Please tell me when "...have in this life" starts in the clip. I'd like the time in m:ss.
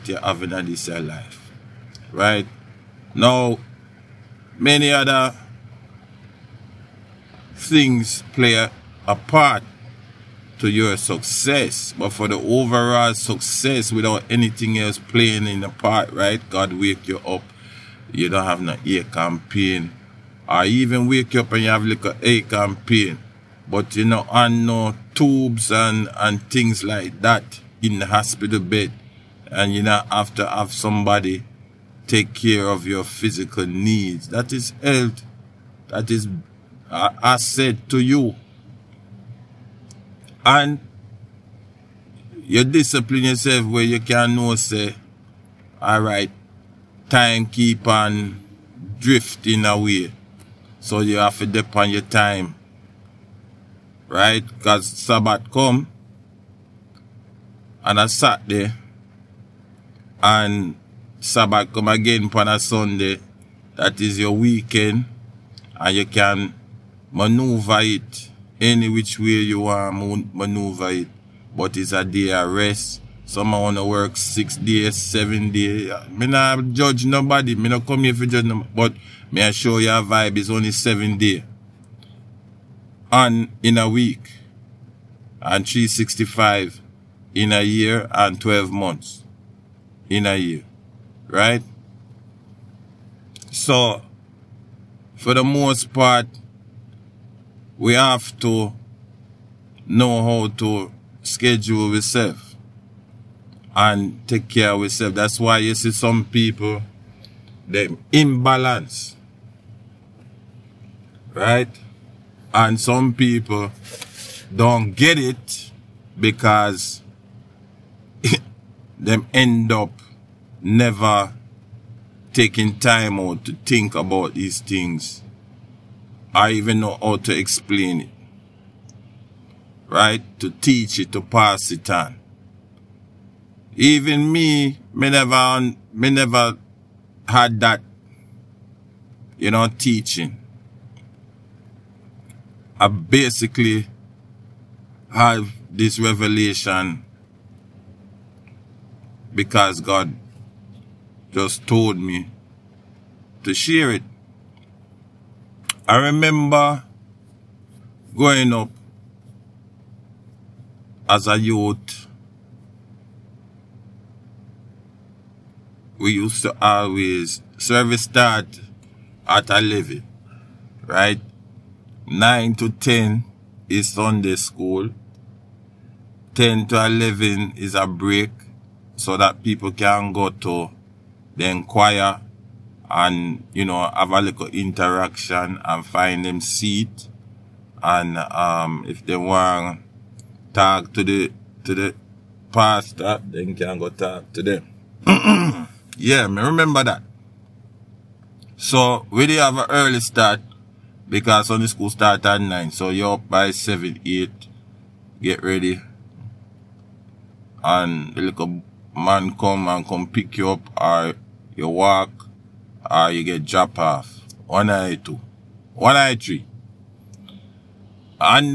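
0:00.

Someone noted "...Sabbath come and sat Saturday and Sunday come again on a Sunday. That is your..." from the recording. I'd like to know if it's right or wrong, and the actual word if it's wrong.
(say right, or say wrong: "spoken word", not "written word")
wrong: "Sabbath", not "Sunday".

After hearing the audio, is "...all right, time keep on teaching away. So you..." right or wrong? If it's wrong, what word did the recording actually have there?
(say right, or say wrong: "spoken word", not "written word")
wrong: "drifting", not "teaching".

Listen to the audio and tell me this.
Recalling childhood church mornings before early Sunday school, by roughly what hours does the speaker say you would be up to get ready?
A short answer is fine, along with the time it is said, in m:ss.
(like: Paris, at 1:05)
7 or 8, at 3:23.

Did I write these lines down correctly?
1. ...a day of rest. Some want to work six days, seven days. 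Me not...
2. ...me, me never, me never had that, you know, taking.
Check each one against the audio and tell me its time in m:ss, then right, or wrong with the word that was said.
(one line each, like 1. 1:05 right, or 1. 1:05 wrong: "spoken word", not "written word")
1. 1:11 right
2. 2:14 wrong: "teaching", not "taking".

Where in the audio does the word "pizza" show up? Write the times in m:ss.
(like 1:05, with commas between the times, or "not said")
not said.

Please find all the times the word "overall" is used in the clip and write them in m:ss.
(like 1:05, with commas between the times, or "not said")
0:12.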